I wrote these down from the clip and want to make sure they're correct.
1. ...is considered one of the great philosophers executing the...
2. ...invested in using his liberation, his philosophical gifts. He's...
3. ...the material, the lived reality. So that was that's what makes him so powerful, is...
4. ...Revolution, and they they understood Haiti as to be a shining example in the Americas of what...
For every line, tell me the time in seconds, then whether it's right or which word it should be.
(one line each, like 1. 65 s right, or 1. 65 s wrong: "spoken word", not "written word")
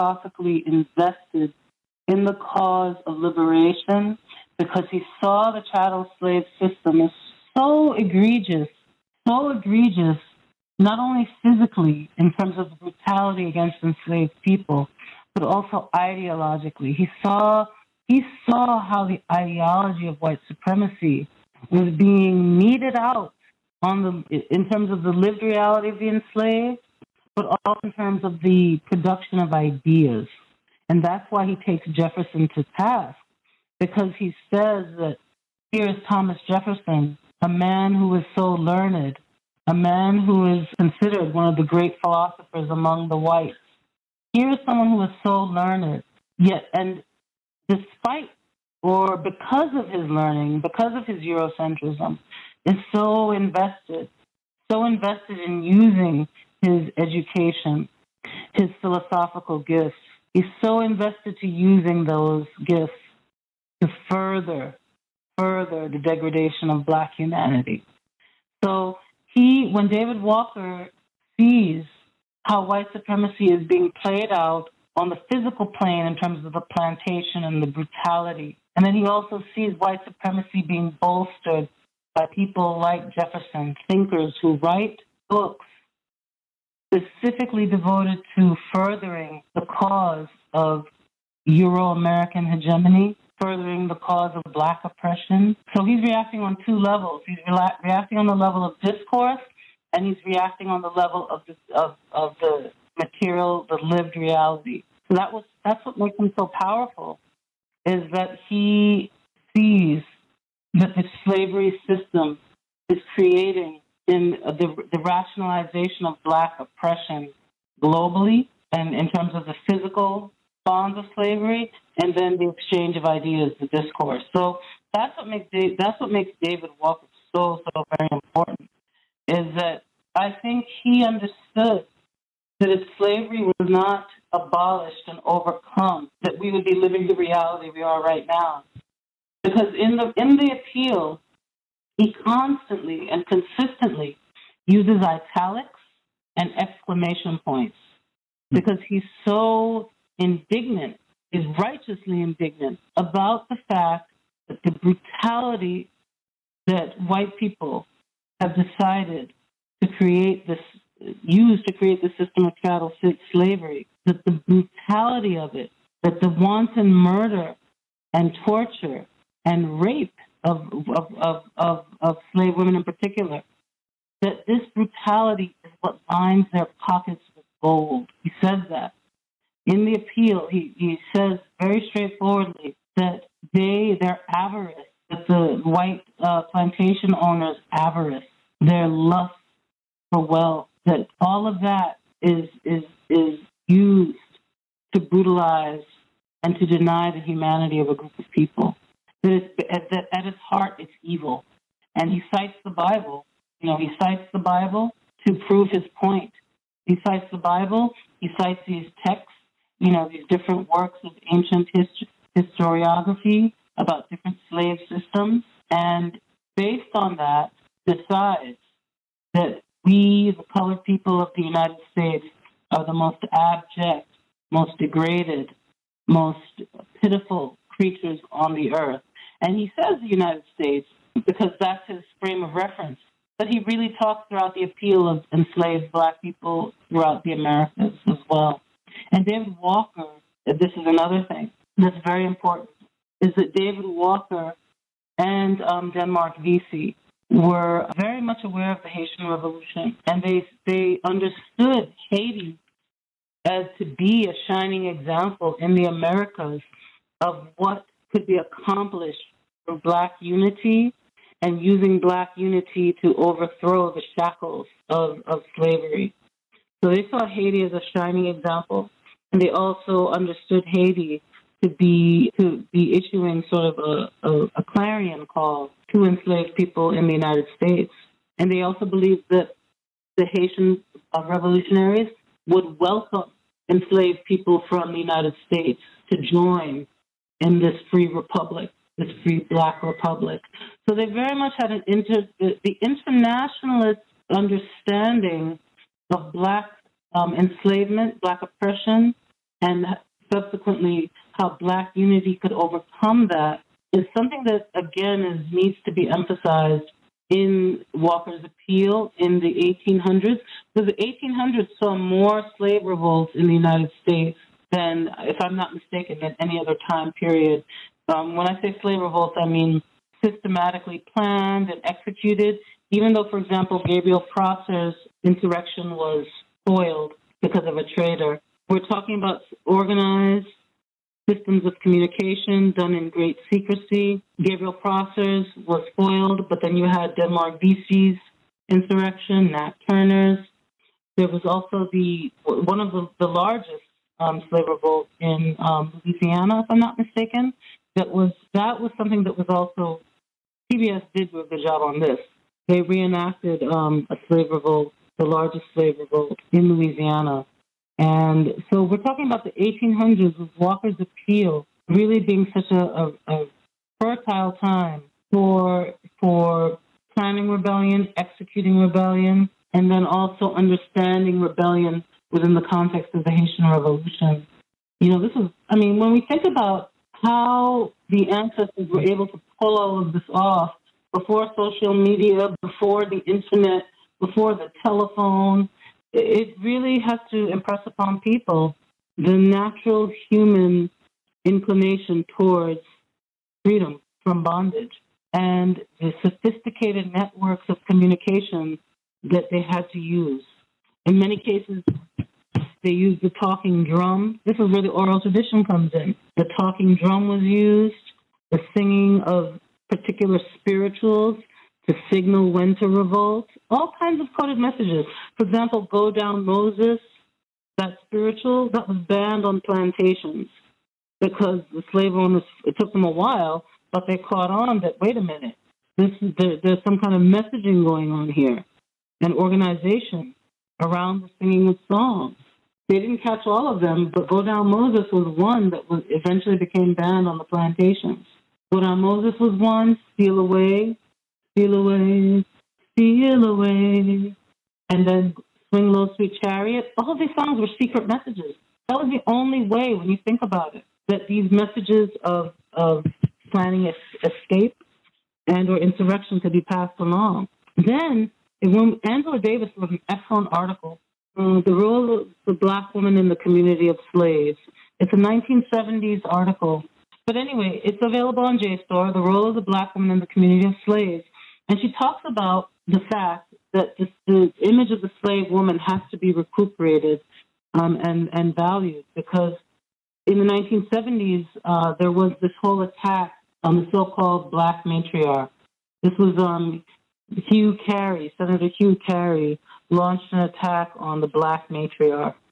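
1. 40 s wrong: "among", not "executing"
2. 54 s wrong: "education", not "liberation"
3. 102 s right
4. 249 s right.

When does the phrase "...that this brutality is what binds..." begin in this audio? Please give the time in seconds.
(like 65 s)
174 s.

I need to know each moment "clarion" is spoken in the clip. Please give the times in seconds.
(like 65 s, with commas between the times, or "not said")
274 s.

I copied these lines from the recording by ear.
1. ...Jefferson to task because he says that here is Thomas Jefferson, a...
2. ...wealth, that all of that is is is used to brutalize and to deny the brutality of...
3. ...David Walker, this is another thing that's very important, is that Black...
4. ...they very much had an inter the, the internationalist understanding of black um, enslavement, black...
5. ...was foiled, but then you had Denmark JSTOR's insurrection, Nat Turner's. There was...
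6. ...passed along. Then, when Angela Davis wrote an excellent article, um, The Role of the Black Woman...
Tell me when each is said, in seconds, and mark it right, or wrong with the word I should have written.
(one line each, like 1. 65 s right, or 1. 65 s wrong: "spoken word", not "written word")
1. 31 s right
2. 190 s wrong: "humanity", not "brutality"
3. 239 s wrong: "David", not "Black"
4. 290 s right
5. 335 s wrong: "Vesey", not "JSTOR"
6. 456 s right.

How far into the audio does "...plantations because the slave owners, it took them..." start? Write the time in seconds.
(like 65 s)
419 s.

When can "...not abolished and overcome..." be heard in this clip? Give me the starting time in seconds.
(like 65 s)
133 s.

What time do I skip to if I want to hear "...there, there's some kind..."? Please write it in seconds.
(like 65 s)
426 s.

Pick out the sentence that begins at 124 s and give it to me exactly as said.
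So that's what makes Dave, that's what makes David Walker so so very important.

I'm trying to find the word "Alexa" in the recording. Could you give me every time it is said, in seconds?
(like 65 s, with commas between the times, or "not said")
not said.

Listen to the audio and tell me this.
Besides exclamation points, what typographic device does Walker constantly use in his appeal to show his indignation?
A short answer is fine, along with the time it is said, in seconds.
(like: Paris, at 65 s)
italics, at 145 s.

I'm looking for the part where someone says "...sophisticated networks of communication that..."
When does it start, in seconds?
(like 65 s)
396 s.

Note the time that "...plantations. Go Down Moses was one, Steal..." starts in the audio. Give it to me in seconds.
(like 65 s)
437 s.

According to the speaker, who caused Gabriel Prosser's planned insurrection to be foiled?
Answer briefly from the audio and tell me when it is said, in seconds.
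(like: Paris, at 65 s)
a traitor, at 327 s.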